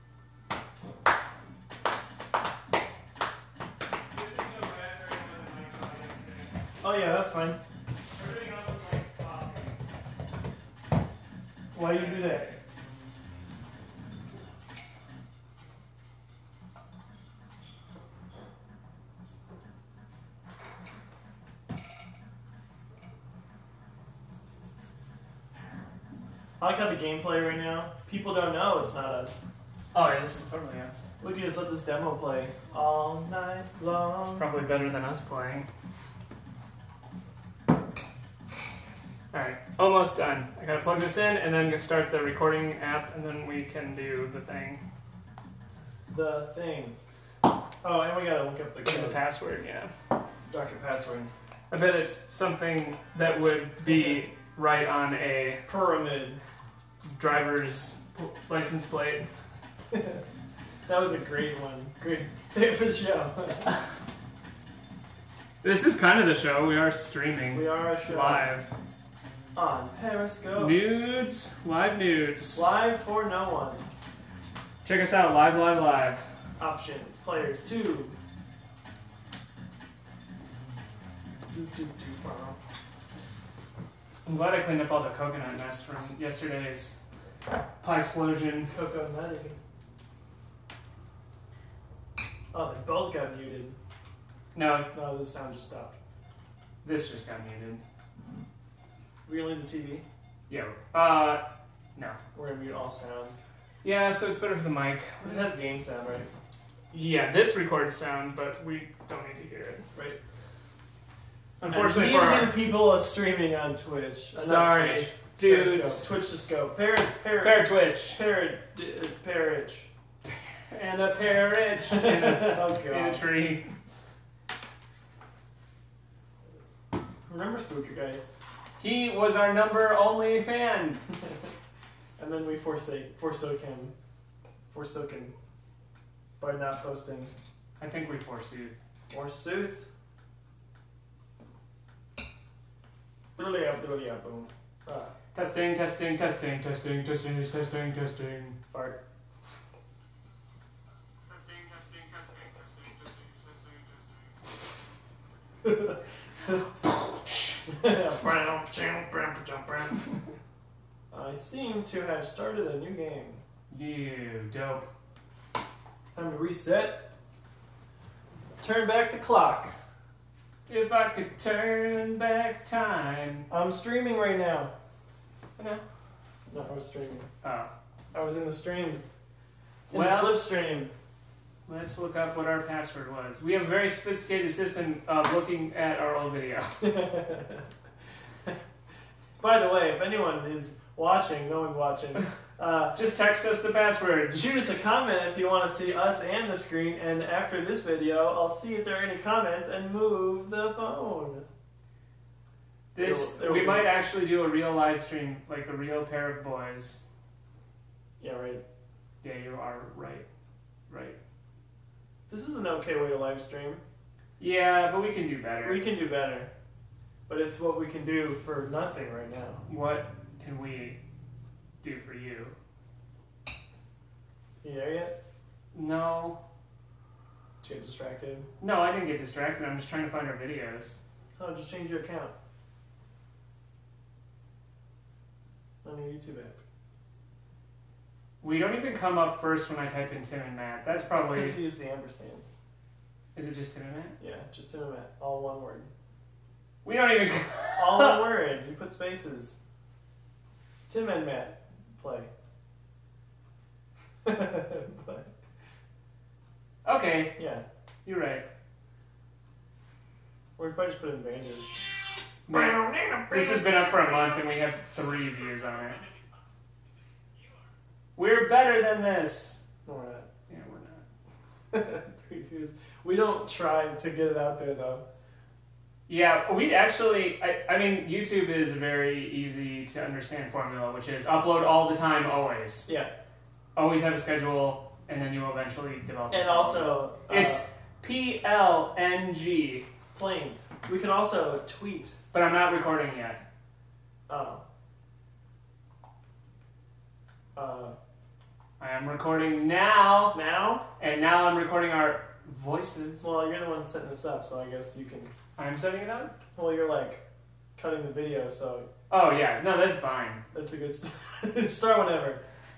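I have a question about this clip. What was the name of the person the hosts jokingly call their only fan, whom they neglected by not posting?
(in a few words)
Spooker.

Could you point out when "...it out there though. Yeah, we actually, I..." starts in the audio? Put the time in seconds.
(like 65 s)
274 s.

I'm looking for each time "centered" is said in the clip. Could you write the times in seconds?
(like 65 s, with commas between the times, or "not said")
not said.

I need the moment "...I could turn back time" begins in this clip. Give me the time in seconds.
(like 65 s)
170 s.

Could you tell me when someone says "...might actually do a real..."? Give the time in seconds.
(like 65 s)
203 s.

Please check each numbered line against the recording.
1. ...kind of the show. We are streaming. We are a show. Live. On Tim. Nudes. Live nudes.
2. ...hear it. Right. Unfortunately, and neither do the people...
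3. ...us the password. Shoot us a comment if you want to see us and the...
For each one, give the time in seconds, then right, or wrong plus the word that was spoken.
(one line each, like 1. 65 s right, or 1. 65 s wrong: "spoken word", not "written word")
1. 65 s wrong: "Periscope", not "Tim"
2. 109 s right
3. 193 s right.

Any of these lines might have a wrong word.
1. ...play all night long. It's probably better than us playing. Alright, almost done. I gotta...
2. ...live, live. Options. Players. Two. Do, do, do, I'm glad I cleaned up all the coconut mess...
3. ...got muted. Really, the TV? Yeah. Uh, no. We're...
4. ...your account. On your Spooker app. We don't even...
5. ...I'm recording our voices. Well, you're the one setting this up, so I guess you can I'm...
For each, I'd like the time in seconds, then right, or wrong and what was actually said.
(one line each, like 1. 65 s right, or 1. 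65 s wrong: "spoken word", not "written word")
1. 32 s right
2. 75 s right
3. 97 s right
4. 231 s wrong: "YouTube", not "Spooker"
5. 301 s right.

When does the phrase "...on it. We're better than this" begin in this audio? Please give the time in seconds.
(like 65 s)
265 s.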